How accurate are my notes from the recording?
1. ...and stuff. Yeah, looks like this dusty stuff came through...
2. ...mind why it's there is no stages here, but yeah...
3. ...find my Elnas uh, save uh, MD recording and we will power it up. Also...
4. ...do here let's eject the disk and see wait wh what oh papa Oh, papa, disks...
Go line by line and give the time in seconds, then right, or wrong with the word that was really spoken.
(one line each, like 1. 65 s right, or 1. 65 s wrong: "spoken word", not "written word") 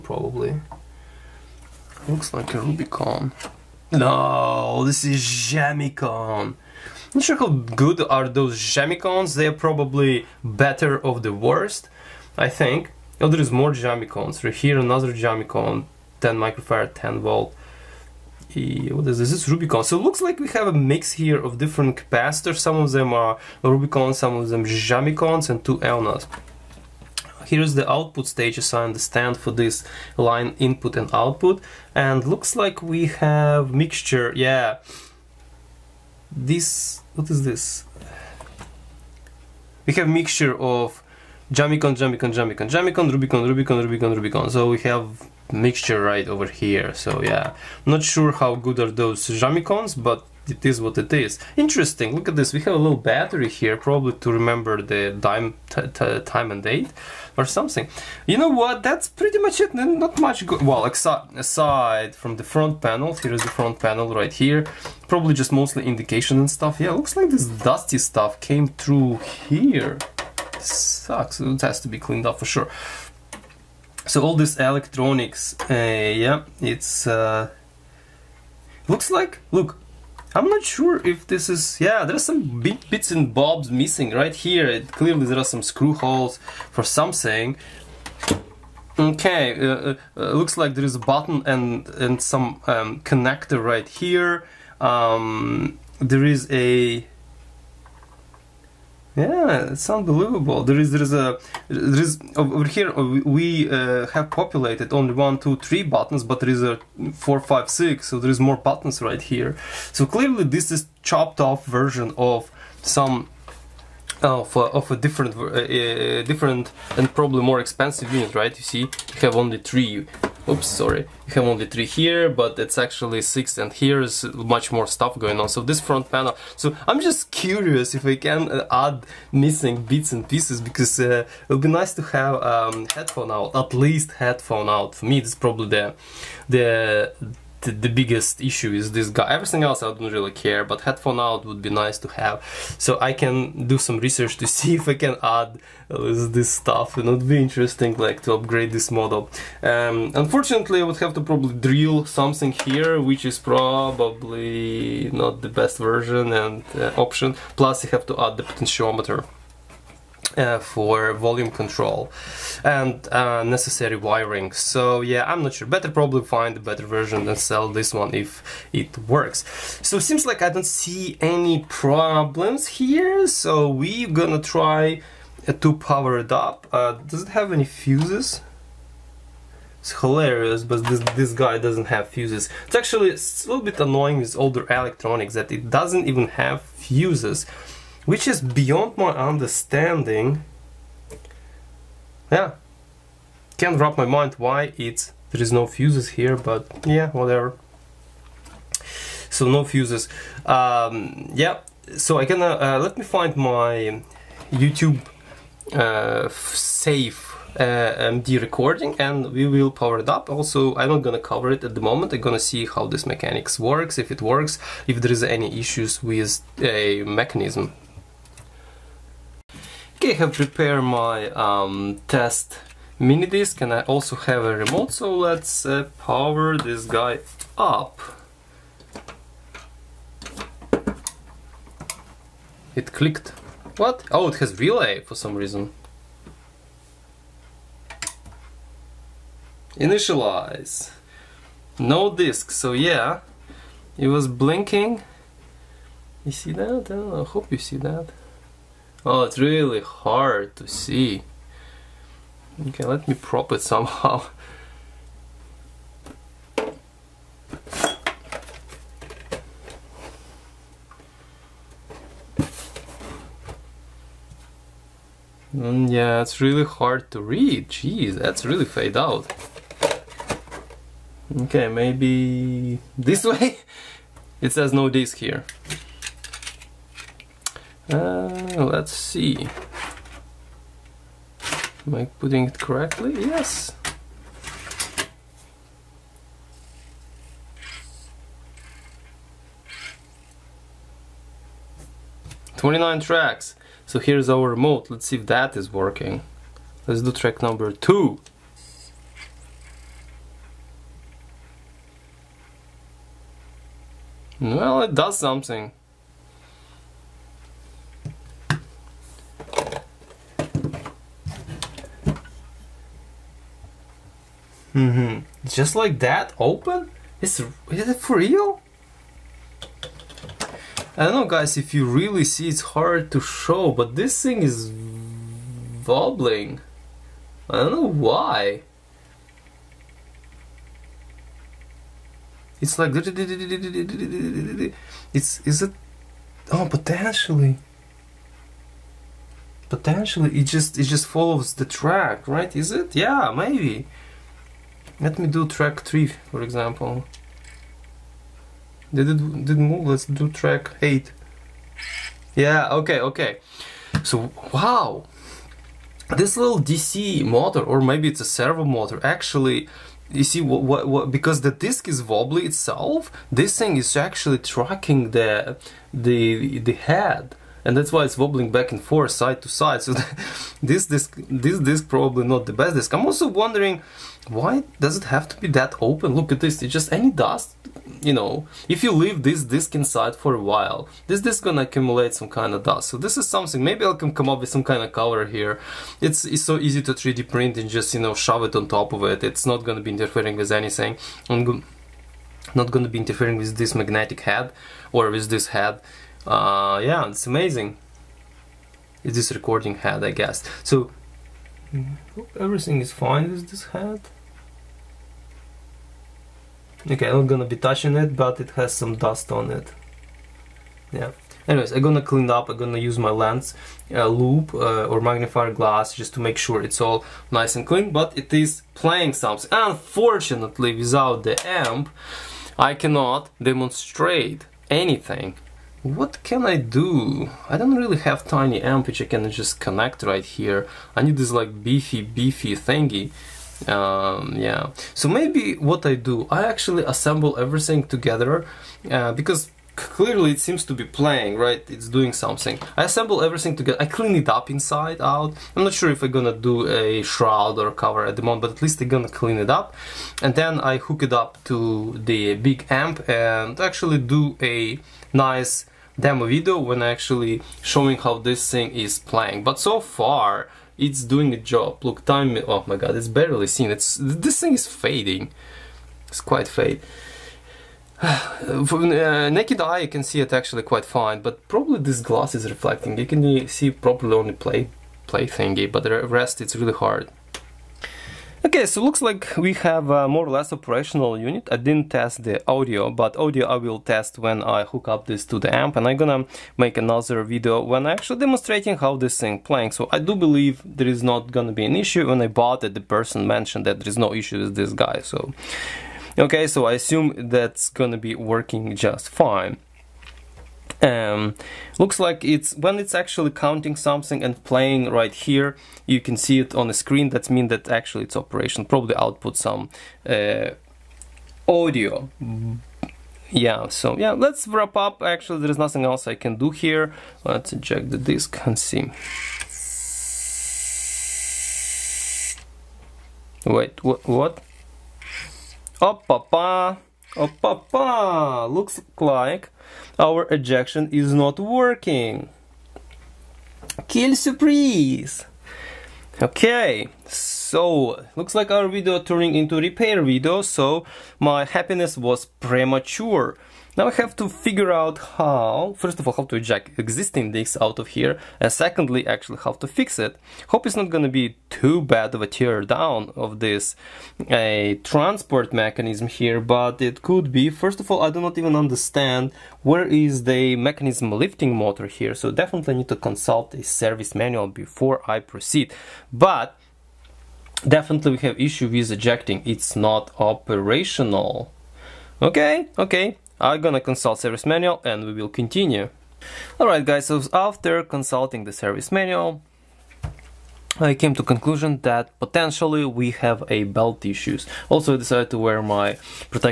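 1. 66 s right
2. 194 s wrong: "fuses", not "stages"
3. 203 s wrong: "YouTube", not "Elnas"
4. 516 s wrong: "looks", not "disks".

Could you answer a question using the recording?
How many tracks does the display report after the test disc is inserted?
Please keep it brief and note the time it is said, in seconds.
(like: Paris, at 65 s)
29, at 292 s.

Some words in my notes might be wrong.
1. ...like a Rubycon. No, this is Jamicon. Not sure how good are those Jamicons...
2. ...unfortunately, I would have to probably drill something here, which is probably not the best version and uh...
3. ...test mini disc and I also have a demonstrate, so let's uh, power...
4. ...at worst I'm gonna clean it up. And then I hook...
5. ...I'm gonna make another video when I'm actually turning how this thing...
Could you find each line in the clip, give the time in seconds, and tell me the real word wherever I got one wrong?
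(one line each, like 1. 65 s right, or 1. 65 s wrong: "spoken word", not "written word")
1. 2 s right
2. 150 s right
3. 222 s wrong: "remote", not "demonstrate"
4. 448 s wrong: "least", not "worst"
5. 485 s wrong: "demonstrating", not "turning".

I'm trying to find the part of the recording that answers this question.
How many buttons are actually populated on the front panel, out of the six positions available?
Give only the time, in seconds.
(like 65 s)
105 s.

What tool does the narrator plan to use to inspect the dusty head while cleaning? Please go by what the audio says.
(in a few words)
magnifier glass.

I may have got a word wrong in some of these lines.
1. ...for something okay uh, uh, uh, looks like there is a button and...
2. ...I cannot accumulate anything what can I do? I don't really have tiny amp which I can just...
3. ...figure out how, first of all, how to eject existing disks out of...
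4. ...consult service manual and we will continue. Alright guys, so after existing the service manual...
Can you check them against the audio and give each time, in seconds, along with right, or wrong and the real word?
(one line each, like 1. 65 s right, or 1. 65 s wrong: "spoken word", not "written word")
1. 86 s right
2. 422 s wrong: "demonstrate", not "accumulate"
3. 544 s right
4. 573 s wrong: "consulting", not "existing".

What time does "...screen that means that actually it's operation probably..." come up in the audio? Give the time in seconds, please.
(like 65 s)
506 s.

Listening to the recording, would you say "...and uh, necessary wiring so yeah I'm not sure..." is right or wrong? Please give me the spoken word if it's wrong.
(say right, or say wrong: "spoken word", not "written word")
right.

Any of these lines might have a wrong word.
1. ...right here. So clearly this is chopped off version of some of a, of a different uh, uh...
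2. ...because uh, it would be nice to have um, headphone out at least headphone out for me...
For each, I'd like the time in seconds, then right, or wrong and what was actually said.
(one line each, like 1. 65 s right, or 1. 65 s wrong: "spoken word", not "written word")
1. 109 s right
2. 130 s right.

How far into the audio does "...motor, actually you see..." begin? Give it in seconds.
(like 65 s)
358 s.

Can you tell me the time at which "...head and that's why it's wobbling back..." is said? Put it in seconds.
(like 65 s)
366 s.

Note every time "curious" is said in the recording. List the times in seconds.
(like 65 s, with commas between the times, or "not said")
127 s.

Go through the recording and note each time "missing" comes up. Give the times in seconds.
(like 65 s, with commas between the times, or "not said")
83 s, 129 s.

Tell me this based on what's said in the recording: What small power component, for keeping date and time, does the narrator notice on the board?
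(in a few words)
battery.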